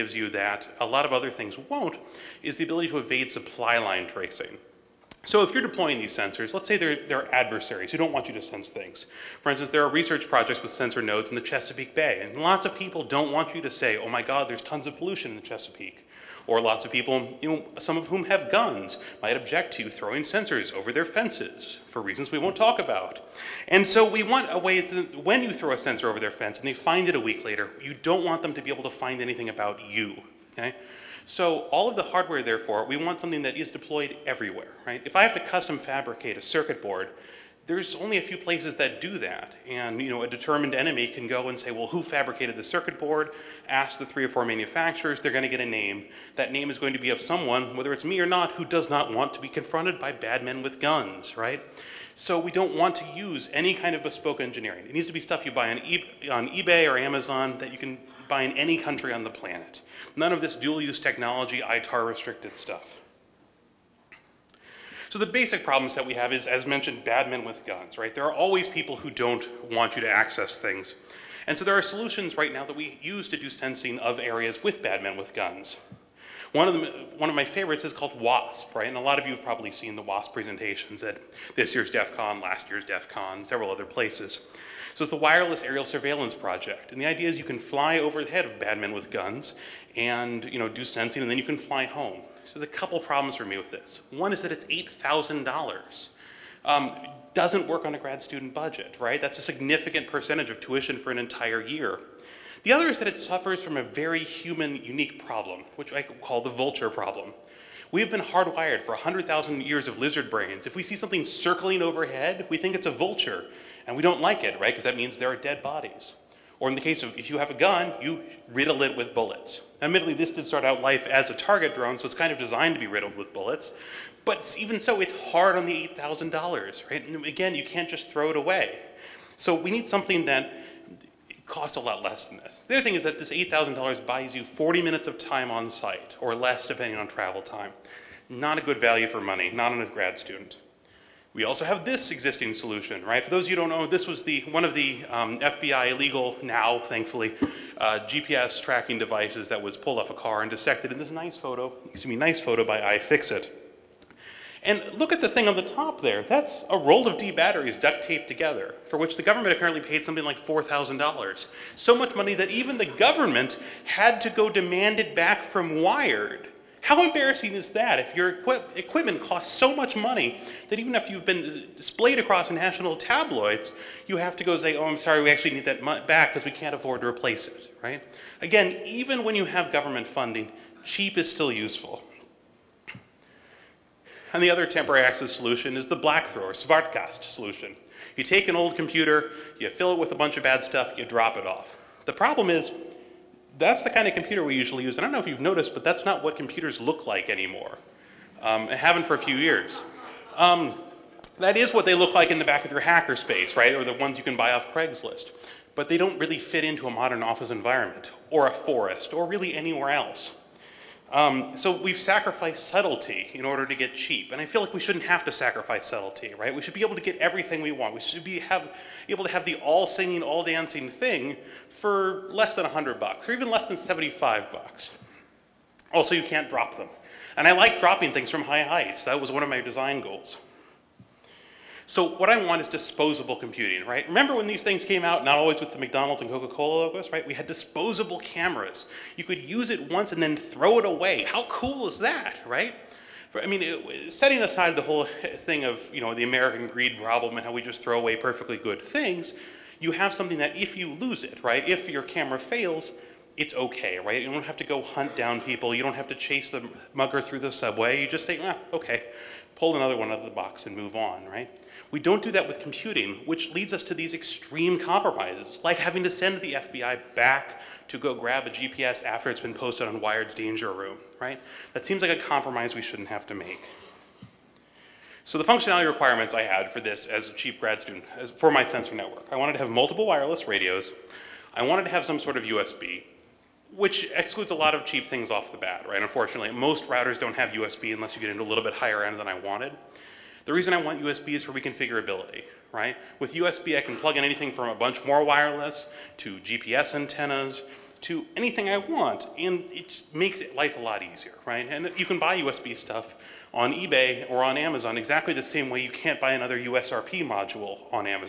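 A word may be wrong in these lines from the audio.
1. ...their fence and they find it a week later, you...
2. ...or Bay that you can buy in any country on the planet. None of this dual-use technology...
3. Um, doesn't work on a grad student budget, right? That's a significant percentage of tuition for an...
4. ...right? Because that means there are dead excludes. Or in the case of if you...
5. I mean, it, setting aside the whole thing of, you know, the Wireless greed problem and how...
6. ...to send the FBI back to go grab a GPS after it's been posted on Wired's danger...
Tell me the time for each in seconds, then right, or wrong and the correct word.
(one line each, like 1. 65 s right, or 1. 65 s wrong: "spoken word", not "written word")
1. 26 s right
2. 56 s wrong: "Amazon", not "Bay"
3. 96 s right
4. 114 s wrong: "bodies", not "excludes"
5. 243 s wrong: "American", not "Wireless"
6. 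266 s right.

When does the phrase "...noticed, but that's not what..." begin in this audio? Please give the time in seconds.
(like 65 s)
195 s.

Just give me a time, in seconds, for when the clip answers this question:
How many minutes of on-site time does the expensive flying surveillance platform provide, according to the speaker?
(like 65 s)
134 s.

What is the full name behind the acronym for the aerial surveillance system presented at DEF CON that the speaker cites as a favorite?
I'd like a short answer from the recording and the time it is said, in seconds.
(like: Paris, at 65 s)
Wireless Aerial Surveillance Project, at 85 s.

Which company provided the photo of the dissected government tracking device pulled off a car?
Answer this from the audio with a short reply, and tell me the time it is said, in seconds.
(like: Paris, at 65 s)
iFixit, at 152 s.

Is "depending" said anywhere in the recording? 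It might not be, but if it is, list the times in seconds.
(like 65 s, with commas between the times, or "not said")
136 s.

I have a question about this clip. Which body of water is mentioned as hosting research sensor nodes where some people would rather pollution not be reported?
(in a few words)
Chesapeake Bay.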